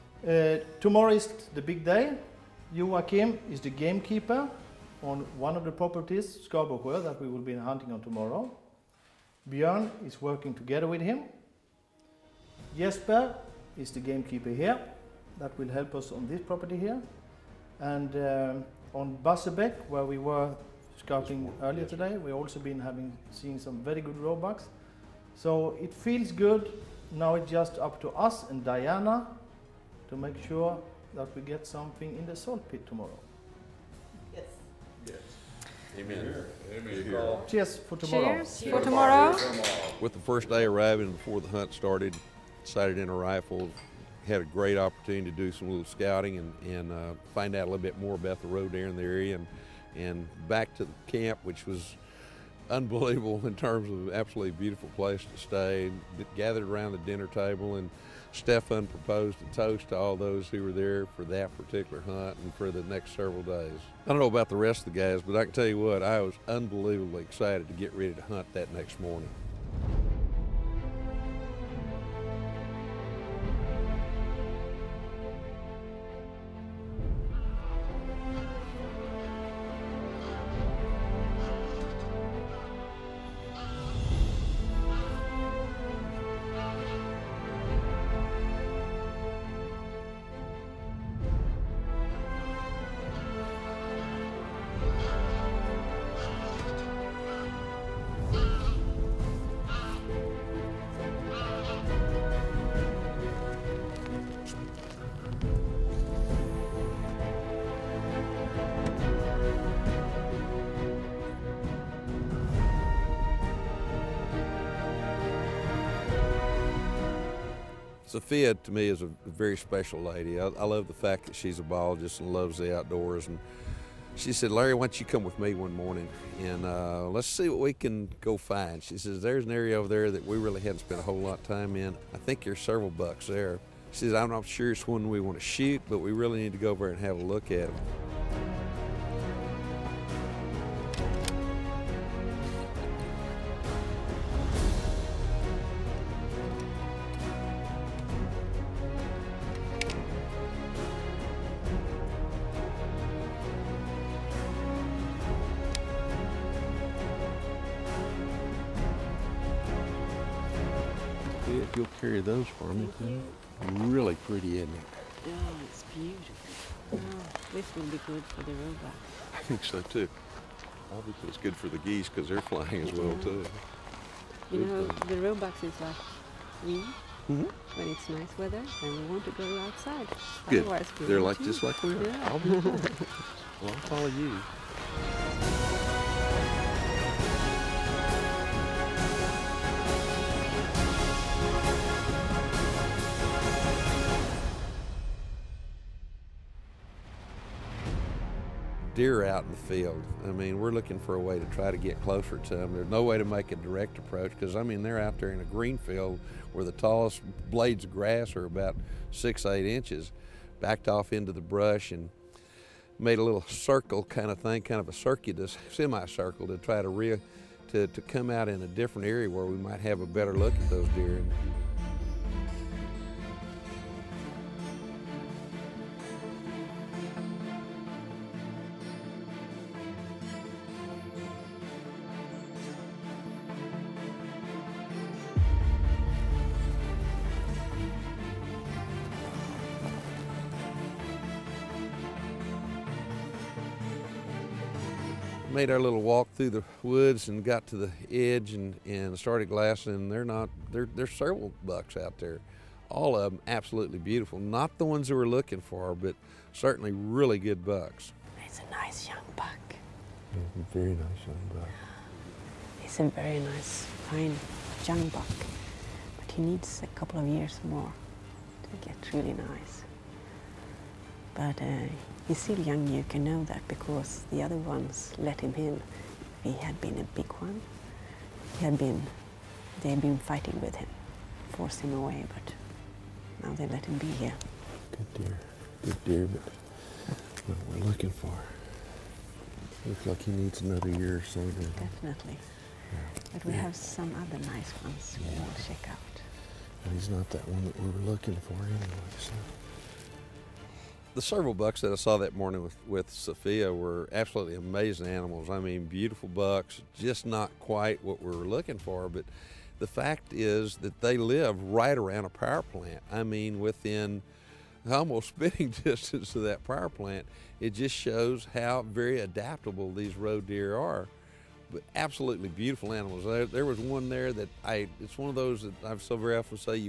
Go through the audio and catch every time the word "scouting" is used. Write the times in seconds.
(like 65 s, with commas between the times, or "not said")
20 s, 45 s.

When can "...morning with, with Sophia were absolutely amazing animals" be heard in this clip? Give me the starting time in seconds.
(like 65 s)
302 s.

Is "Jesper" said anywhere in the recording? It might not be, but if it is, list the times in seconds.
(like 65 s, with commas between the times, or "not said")
12 s.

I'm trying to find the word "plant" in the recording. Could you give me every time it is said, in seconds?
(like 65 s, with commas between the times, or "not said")
312 s, 316 s.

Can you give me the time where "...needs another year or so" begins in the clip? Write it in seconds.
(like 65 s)
290 s.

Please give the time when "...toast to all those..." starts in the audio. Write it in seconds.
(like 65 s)
59 s.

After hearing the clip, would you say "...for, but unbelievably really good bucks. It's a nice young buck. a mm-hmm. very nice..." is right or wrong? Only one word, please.
wrong.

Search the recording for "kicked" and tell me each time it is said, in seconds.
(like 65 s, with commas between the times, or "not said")
not said.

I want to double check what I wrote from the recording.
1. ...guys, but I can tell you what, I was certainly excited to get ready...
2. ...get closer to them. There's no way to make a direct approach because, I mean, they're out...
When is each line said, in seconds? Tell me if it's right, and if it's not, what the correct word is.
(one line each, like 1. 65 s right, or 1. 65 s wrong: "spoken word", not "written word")
1. 64 s wrong: "unbelievably", not "certainly"
2. 201 s right.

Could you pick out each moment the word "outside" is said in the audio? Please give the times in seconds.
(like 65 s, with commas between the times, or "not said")
179 s.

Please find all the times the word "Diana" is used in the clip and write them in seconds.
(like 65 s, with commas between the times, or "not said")
28 s.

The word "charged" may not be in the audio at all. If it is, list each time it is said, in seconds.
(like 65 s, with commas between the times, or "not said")
not said.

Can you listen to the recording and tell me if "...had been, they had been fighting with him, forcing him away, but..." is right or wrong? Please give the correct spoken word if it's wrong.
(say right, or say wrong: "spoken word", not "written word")
right.